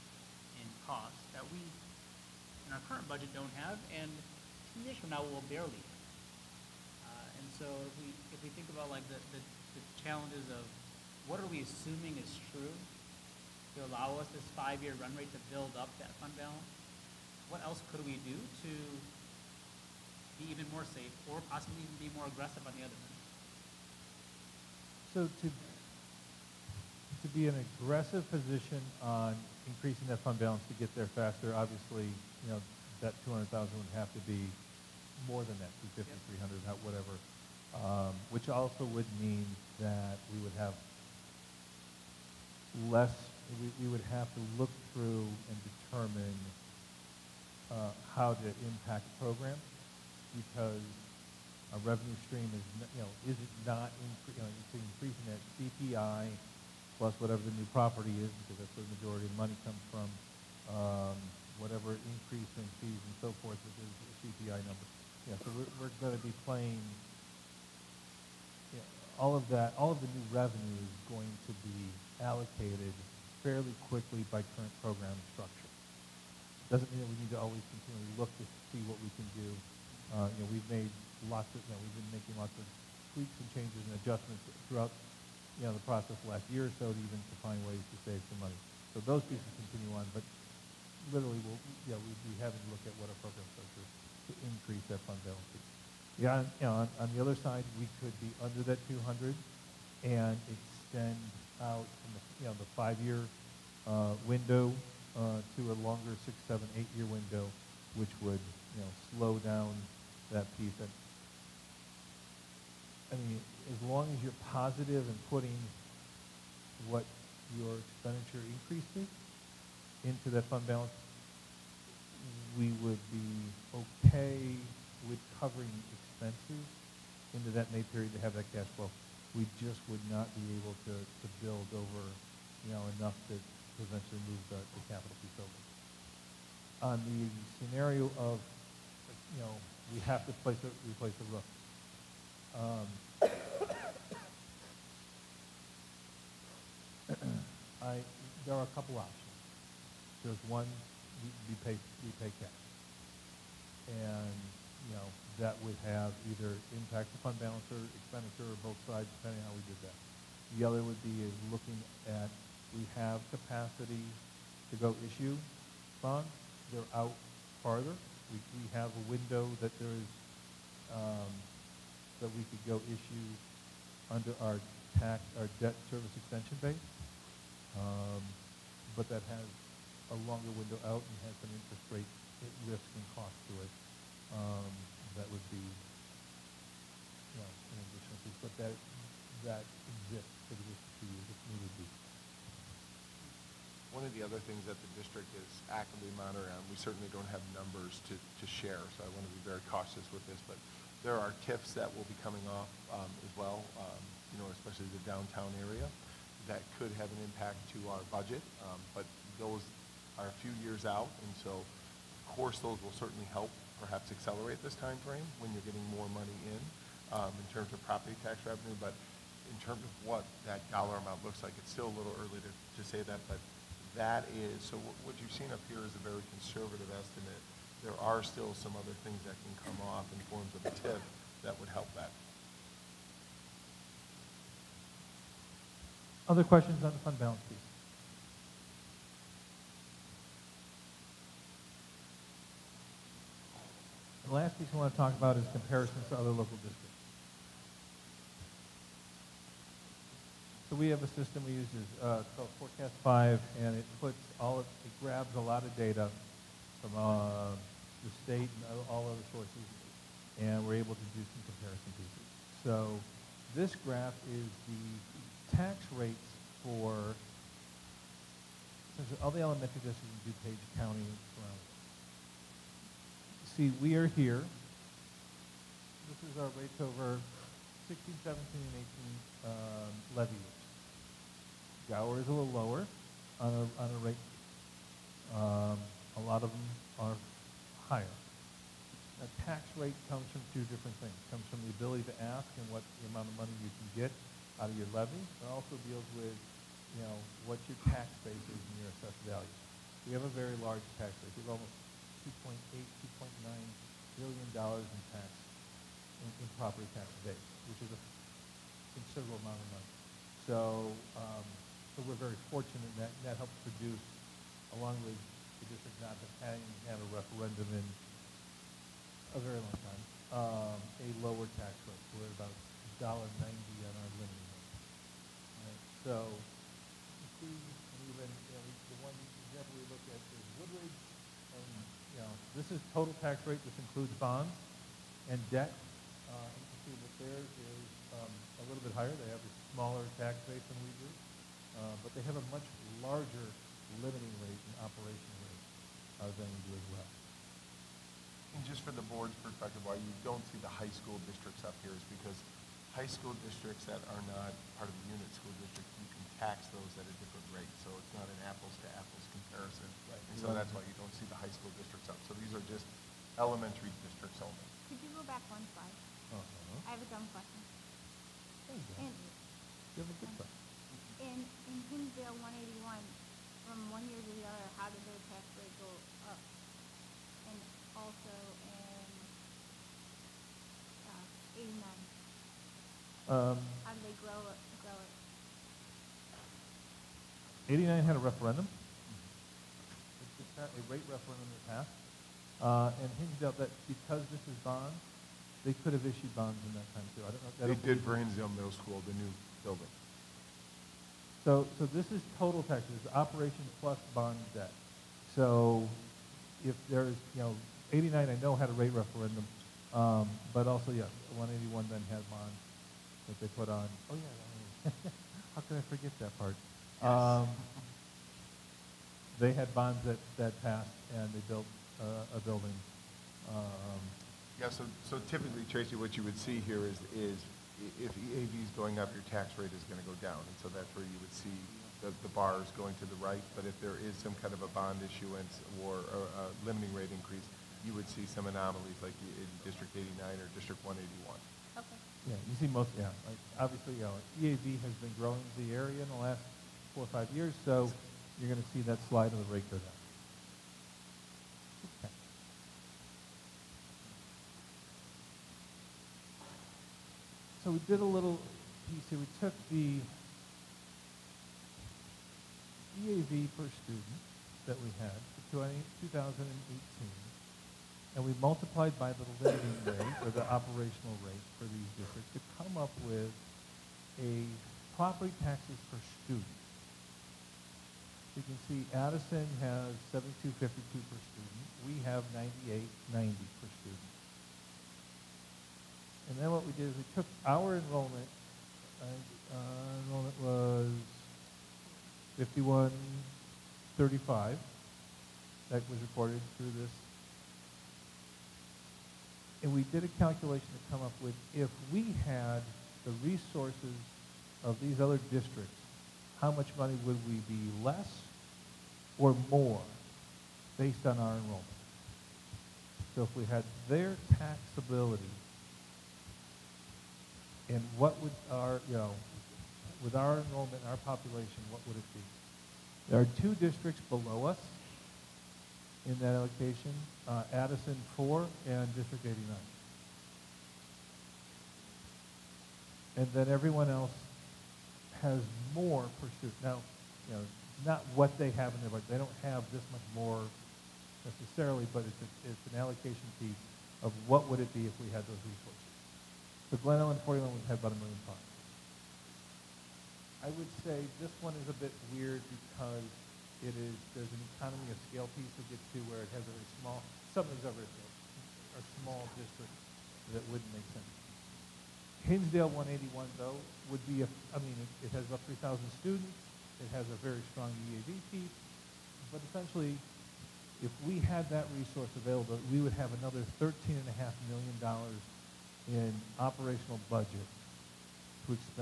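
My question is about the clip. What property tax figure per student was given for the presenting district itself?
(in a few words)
98.90.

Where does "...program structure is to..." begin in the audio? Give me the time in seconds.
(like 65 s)
93 s.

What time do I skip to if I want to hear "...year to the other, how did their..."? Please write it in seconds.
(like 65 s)
374 s.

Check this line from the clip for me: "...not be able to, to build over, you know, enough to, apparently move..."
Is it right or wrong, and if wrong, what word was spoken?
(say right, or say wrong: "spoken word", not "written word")
wrong: "eventually", not "apparently".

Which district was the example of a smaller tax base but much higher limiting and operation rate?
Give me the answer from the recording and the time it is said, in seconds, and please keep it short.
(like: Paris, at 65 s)
Woodridge, at 330 s.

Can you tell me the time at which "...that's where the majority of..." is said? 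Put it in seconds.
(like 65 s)
58 s.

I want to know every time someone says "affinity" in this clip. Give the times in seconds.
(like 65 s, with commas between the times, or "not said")
not said.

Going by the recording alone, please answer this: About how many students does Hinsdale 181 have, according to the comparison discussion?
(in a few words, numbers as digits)
3,000.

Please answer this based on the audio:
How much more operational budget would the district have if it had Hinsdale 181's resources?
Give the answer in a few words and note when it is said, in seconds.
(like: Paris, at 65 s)
$13.5 million, at 573 s.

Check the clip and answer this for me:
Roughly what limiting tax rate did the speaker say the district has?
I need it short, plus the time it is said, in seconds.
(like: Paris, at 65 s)
$1.90, at 323 s.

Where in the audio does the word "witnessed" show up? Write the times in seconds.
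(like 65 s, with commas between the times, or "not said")
not said.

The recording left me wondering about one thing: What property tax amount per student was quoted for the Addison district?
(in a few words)
72.52.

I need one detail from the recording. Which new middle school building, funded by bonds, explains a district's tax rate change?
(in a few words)
Hinsdale Middle School.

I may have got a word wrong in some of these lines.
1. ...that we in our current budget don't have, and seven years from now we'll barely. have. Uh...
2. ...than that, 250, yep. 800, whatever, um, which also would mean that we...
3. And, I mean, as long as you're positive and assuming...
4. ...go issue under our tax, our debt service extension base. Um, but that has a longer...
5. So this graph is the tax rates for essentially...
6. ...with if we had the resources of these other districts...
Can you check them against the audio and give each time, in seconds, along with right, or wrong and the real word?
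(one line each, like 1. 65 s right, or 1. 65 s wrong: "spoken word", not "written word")
1. 1 s wrong: "two", not "seven"
2. 35 s wrong: "300", not "800"
3. 110 s wrong: "putting", not "assuming"
4. 172 s right
5. 262 s right
6. 501 s right.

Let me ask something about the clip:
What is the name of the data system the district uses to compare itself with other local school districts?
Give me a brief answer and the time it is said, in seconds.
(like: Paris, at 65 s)
Forecast 5, at 252 s.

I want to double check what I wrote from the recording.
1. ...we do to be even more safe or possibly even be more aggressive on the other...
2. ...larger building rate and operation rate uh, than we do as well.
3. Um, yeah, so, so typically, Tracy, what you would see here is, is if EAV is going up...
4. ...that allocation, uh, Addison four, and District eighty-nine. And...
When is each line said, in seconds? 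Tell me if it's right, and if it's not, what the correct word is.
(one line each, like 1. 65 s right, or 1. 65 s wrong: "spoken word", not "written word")
1. 18 s right
2. 343 s wrong: "limiting", not "building"
3. 423 s right
4. 526 s right.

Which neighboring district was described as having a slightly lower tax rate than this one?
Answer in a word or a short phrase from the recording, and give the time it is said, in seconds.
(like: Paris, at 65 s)
Gower, at 281 s.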